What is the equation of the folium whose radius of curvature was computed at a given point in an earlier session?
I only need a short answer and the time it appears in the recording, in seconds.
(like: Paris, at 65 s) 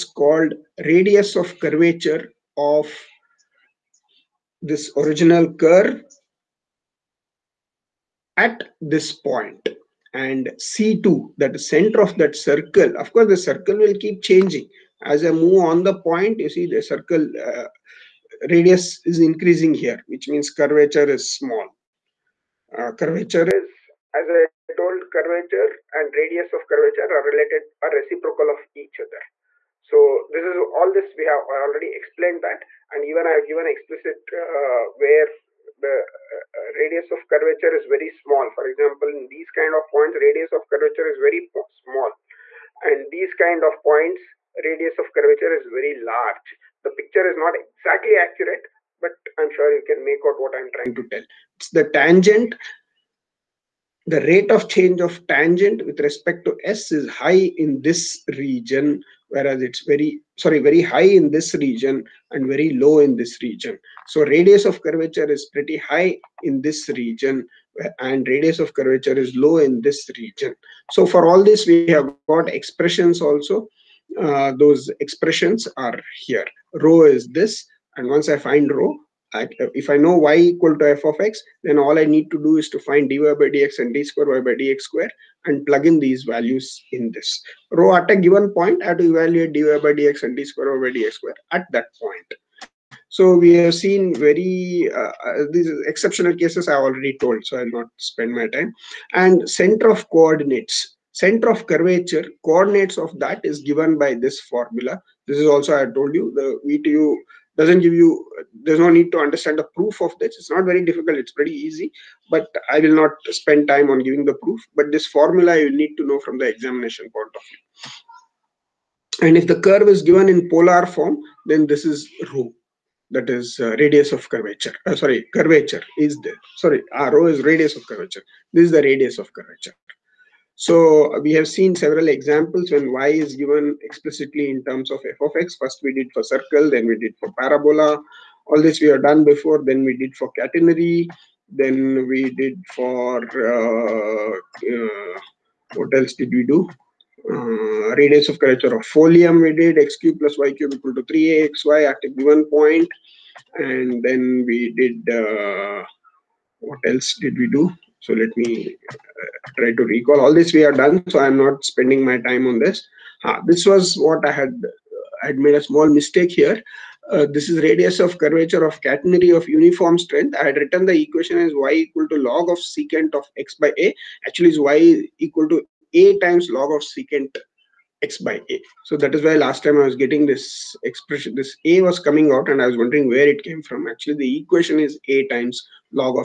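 x³ + y³ = 3axy, at 149 s.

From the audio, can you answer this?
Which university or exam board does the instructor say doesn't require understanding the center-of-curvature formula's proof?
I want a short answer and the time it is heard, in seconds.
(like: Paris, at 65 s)
VTU, at 106 s.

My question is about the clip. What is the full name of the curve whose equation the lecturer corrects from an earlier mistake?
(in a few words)
catenary of uniform strength.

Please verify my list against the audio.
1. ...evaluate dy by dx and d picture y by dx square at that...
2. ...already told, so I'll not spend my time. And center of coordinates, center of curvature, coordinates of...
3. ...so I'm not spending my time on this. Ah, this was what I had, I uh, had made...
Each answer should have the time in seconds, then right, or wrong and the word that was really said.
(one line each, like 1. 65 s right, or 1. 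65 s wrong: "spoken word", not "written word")
1. 89 s wrong: "square", not "picture"
2. 96 s right
3. 161 s right.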